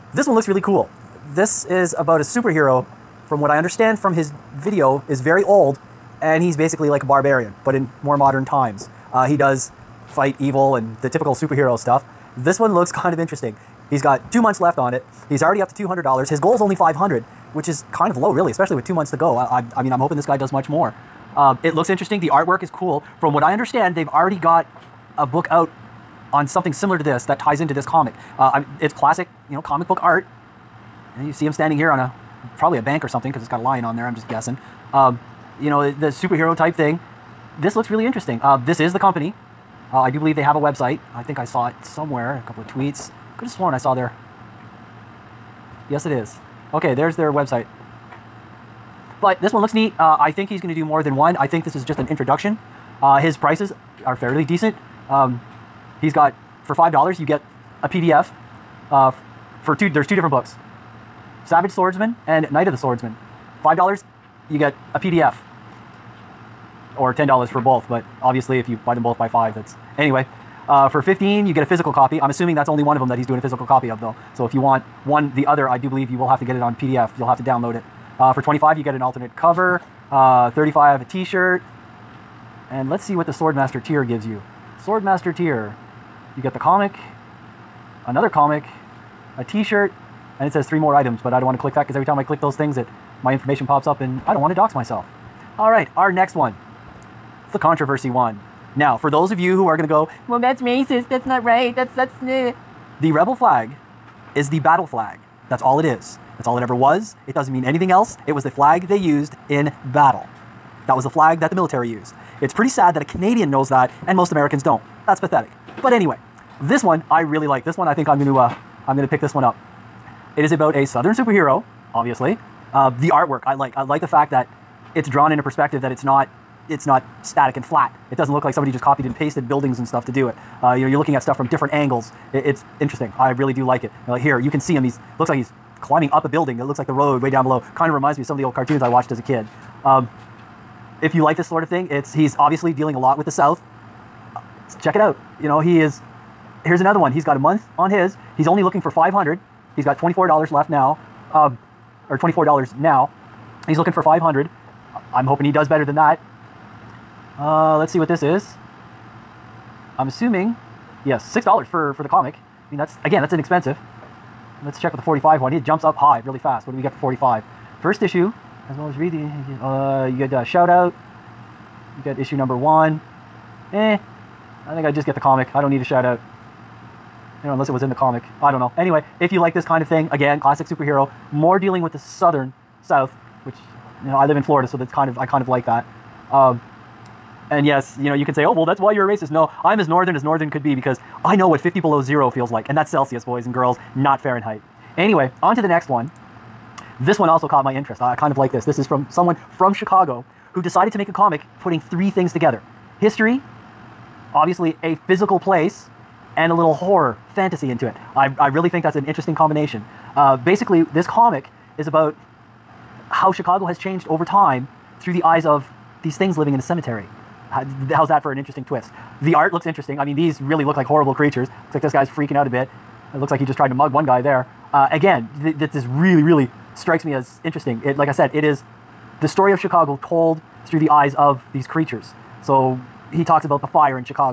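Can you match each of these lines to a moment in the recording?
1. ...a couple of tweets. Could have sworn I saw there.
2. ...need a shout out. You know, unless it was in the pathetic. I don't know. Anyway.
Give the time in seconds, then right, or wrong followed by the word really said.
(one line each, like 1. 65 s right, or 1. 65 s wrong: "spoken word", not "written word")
1. 42 s right
2. 175 s wrong: "comic", not "pathetic".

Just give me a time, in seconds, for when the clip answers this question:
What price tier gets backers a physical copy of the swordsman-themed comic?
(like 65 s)
70 s.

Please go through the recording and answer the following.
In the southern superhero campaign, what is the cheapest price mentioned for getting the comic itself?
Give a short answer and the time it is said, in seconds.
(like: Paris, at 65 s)
$6, at 161 s.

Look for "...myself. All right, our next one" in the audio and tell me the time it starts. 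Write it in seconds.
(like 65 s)
94 s.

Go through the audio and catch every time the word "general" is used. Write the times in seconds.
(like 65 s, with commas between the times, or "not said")
not said.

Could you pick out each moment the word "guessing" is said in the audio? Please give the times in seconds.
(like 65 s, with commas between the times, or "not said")
34 s.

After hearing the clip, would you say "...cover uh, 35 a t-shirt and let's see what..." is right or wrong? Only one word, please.
right.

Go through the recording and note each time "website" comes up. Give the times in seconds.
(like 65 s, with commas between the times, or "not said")
40 s, 47 s.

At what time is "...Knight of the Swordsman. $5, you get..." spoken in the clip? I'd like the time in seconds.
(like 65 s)
62 s.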